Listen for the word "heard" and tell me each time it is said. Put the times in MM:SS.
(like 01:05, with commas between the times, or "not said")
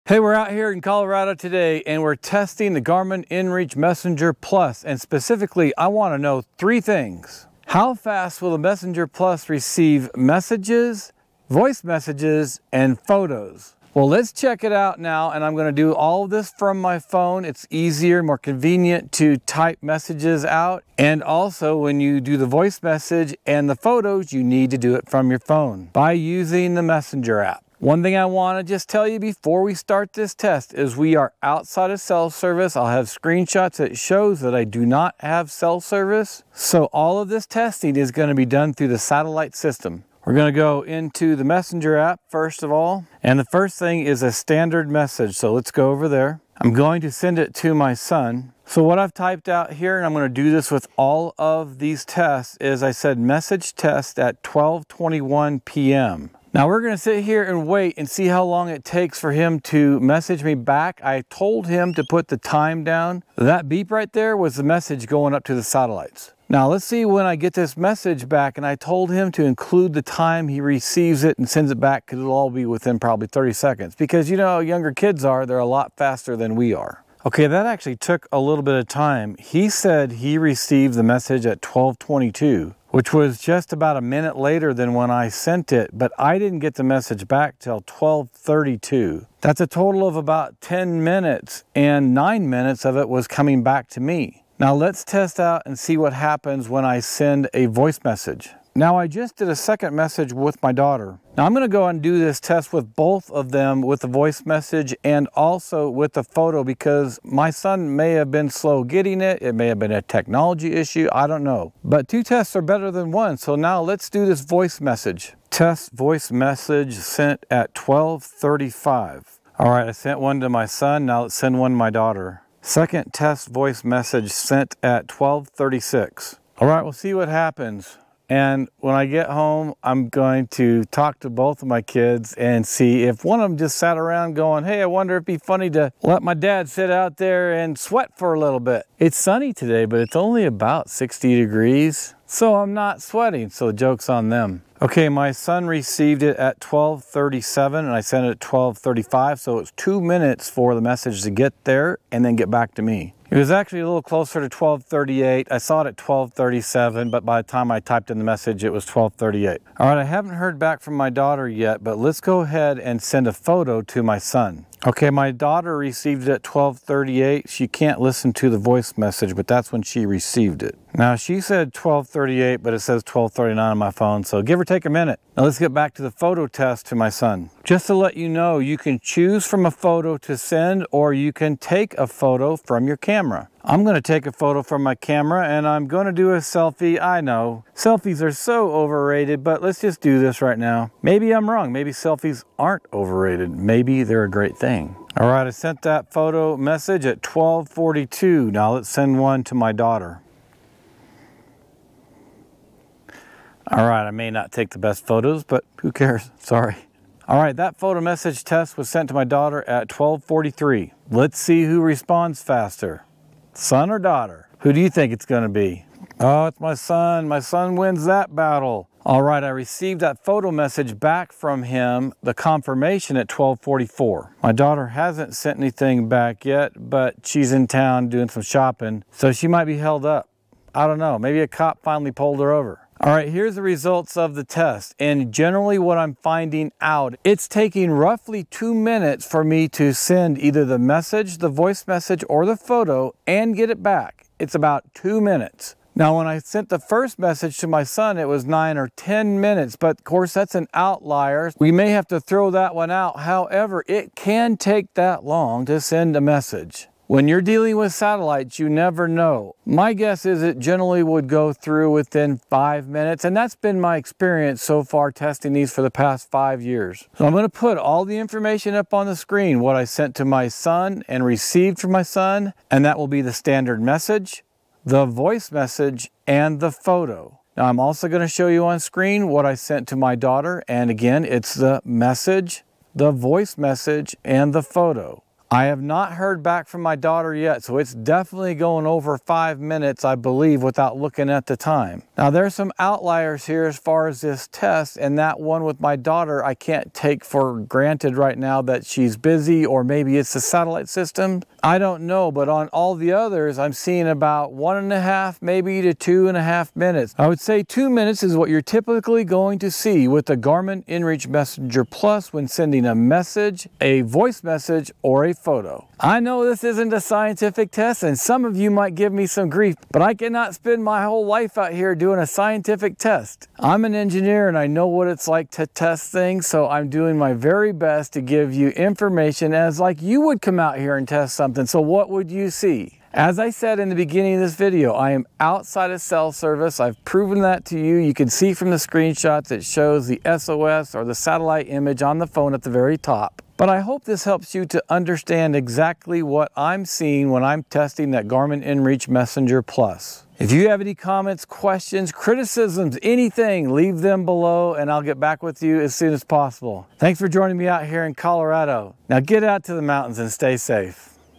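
02:40, 04:46.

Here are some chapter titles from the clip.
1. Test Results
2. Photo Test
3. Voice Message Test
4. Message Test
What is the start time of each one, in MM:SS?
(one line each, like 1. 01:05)
1. 03:52
2. 02:55
3. 01:53
4. 00:43.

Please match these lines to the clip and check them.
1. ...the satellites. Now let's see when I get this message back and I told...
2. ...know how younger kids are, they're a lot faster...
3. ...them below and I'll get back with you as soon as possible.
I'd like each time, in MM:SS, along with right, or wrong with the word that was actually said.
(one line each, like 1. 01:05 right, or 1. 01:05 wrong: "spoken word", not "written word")
1. 01:05 right
2. 01:14 right
3. 05:53 right.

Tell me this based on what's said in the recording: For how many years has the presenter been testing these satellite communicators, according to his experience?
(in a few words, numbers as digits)
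5.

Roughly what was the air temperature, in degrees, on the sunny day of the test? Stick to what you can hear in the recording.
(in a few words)
60.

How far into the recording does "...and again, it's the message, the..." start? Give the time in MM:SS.
04:40.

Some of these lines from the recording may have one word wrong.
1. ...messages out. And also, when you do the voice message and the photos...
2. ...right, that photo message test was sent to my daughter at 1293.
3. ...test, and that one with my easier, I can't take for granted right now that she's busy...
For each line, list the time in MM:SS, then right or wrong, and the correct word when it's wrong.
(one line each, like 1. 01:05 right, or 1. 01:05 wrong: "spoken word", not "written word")
1. 00:19 right
2. 03:27 wrong: "1243", not "1293"
3. 04:54 wrong: "daughter", not "easier".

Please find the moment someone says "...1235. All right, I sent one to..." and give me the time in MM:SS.
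01:57.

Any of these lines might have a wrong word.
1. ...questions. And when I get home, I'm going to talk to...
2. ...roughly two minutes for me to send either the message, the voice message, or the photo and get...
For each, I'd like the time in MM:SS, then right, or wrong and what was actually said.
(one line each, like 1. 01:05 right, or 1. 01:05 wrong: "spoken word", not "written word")
1. 02:07 wrong: "happens", not "questions"
2. 03:57 right.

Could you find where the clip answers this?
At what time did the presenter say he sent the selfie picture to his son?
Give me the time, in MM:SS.
03:17.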